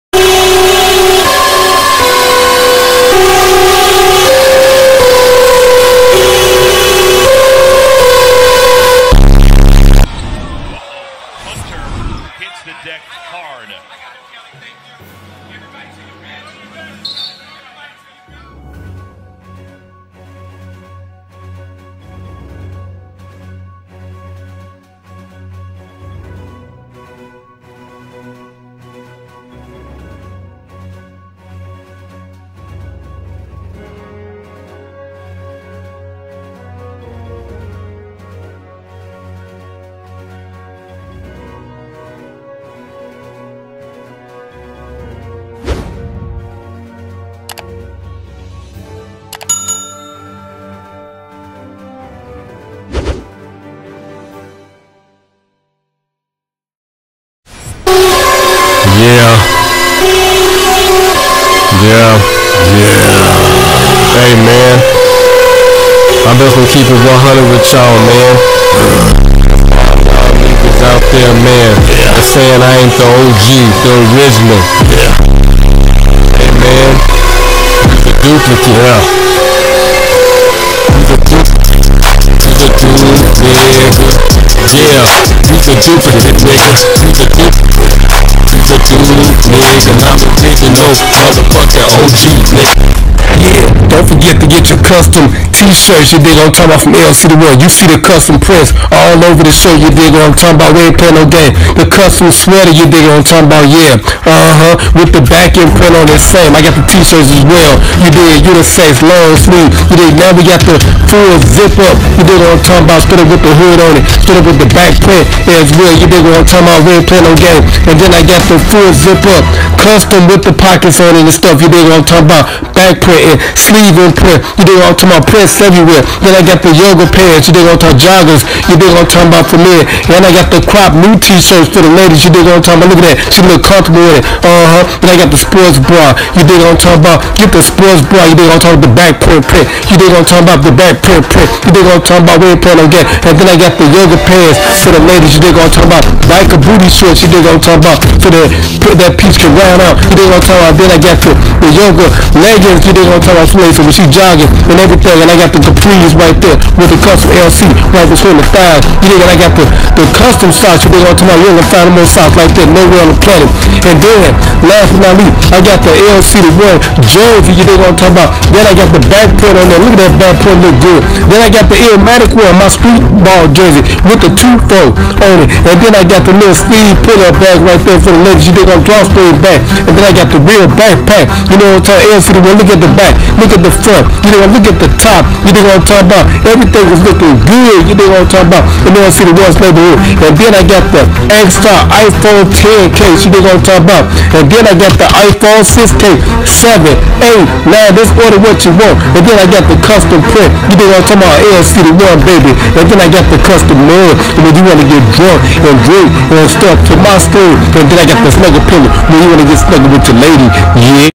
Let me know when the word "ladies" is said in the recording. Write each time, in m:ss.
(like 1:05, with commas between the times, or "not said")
2:11, 2:25.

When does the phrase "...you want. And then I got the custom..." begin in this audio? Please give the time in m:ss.
3:18.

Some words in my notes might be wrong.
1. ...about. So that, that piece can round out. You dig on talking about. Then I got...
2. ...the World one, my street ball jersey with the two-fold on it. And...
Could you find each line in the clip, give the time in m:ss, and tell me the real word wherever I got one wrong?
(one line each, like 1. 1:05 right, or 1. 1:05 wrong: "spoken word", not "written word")
1. 2:27 right
2. 2:51 wrong: "Illmatic", not "World".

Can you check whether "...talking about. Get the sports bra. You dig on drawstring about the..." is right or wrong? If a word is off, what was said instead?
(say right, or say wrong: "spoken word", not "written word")
wrong: "talking", not "drawstring".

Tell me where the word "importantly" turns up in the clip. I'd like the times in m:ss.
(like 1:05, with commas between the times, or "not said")
not said.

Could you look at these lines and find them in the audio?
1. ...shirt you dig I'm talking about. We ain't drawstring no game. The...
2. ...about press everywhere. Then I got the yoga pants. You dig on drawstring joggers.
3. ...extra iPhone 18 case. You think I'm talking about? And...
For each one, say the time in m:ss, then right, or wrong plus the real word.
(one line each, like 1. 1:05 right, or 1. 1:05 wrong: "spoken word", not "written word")
1. 1:39 wrong: "playing", not "drawstring"
2. 2:05 wrong: "talking", not "drawstring"
3. 3:11 wrong: "10", not "18".